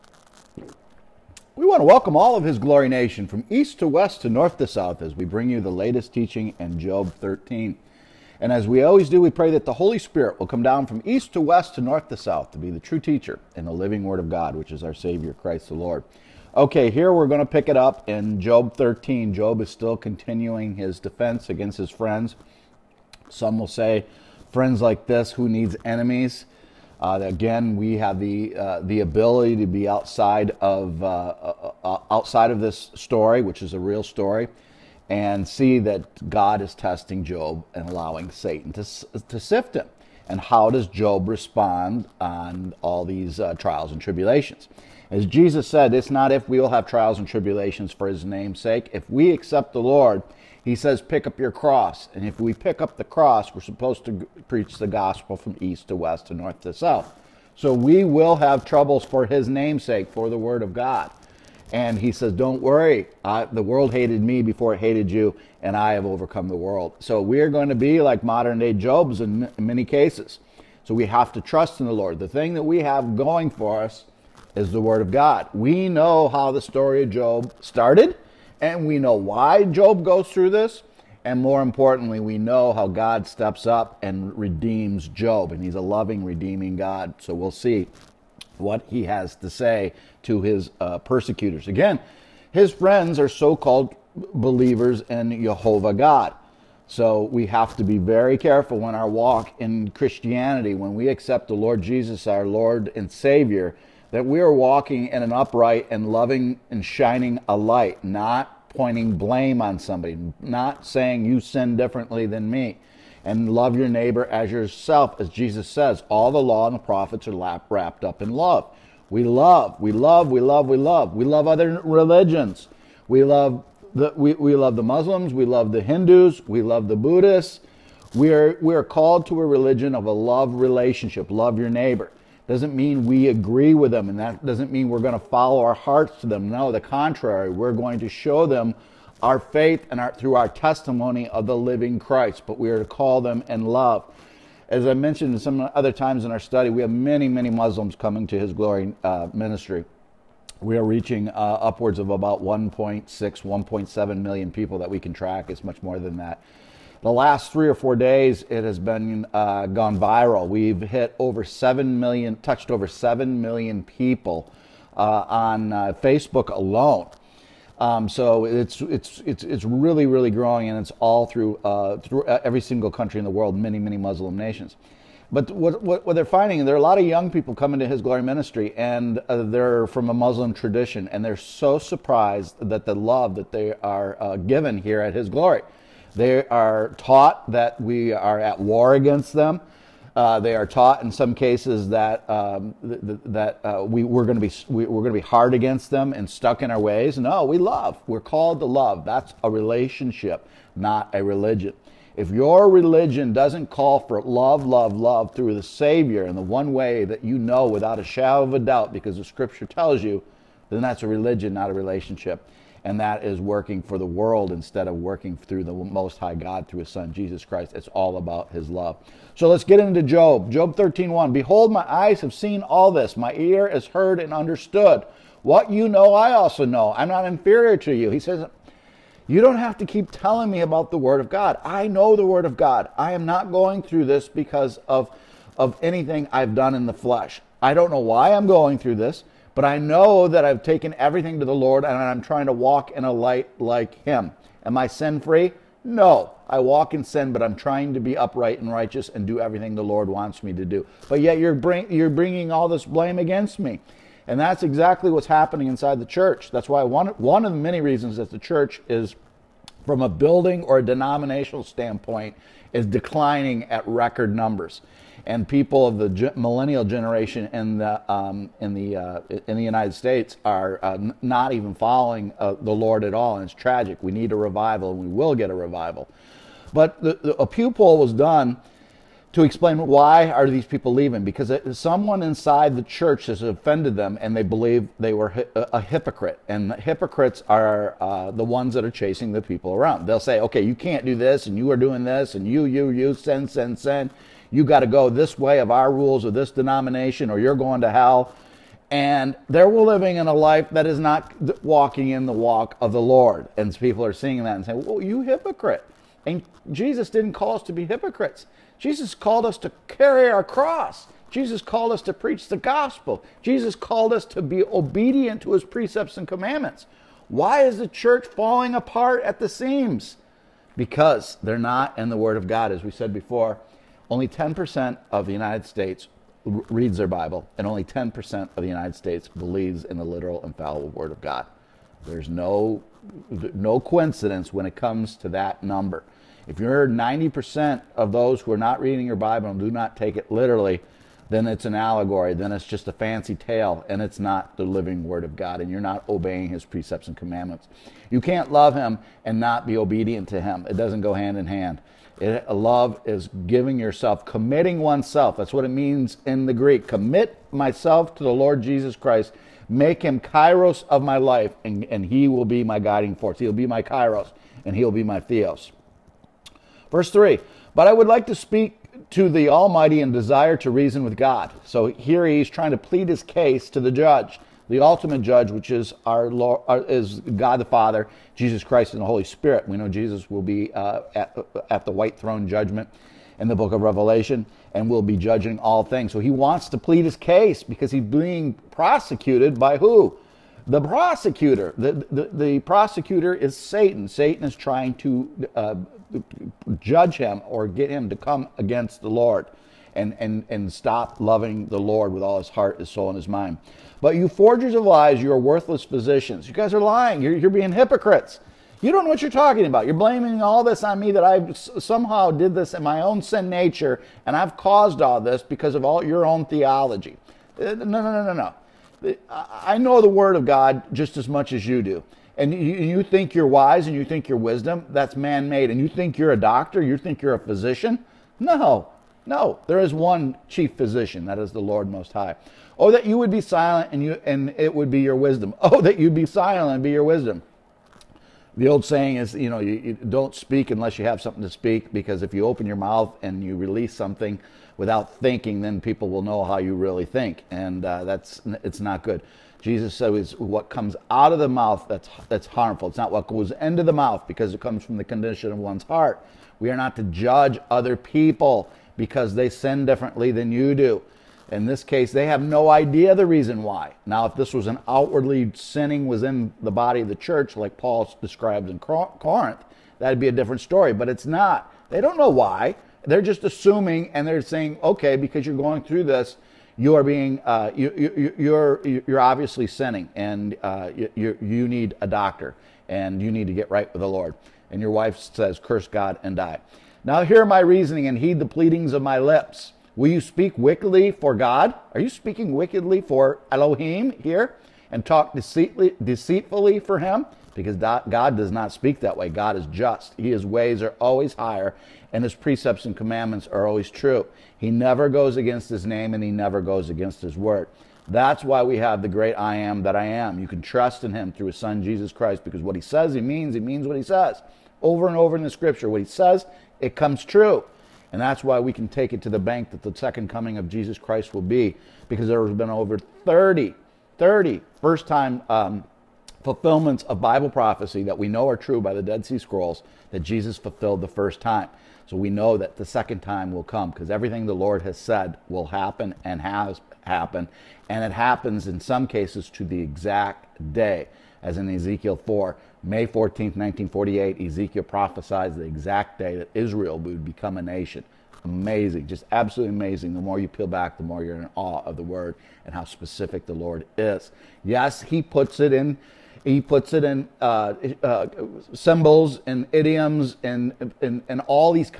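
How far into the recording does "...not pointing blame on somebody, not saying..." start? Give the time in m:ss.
1:48.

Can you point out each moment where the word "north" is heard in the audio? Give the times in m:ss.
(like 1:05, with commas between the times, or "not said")
0:04, 0:11, 0:56.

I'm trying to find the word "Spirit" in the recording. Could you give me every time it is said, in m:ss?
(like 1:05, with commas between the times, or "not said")
0:09, 6:19.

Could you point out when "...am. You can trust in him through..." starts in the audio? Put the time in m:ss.
8:30.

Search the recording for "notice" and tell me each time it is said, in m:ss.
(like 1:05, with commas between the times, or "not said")
not said.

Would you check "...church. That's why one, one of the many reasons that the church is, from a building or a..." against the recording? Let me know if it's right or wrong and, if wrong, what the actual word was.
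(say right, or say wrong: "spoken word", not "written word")
right.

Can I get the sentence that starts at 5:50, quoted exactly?
It doesn't go hand in hand.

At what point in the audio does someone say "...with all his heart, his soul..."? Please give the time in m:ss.
6:42.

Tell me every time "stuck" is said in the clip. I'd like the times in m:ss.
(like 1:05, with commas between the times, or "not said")
3:16.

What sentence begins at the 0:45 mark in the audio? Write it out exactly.
As Jesus said, it's not if we will have trials and tribulations for His name's sake.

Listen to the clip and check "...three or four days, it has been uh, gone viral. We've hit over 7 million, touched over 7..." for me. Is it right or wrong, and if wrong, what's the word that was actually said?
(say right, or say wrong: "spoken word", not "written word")
right.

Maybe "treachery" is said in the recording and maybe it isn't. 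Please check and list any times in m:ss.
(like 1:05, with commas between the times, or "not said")
not said.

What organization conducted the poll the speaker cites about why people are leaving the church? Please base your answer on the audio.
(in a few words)
Pew.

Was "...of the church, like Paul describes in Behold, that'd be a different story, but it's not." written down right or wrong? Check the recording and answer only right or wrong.
wrong.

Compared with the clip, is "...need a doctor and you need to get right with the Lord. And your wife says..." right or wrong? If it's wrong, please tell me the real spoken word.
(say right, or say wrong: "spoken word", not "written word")
right.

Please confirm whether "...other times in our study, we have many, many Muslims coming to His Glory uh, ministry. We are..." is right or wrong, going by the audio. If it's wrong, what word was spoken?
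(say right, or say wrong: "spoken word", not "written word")
right.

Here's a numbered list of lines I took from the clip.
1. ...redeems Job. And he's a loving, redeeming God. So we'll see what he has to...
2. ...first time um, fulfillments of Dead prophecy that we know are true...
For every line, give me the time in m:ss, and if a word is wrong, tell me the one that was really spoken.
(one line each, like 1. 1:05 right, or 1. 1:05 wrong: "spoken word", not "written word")
1. 1:24 right
2. 8:44 wrong: "Bible", not "Dead".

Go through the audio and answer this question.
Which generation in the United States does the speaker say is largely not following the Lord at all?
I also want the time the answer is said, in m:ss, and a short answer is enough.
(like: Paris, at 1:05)
millennial, at 4:26.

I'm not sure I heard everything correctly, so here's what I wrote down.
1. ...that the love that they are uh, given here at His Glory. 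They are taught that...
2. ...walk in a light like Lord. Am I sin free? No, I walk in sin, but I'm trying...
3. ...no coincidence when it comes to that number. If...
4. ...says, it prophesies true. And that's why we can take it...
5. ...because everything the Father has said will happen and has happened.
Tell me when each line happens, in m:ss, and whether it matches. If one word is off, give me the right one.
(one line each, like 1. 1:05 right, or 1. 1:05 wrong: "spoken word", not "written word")
1. 3:02 right
2. 4:02 wrong: "Him", not "Lord"
3. 5:33 right
4. 8:36 wrong: "comes", not "prophesies"
5. 8:53 wrong: "Lord", not "Father".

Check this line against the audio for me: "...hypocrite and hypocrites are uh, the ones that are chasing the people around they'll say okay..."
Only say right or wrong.
right.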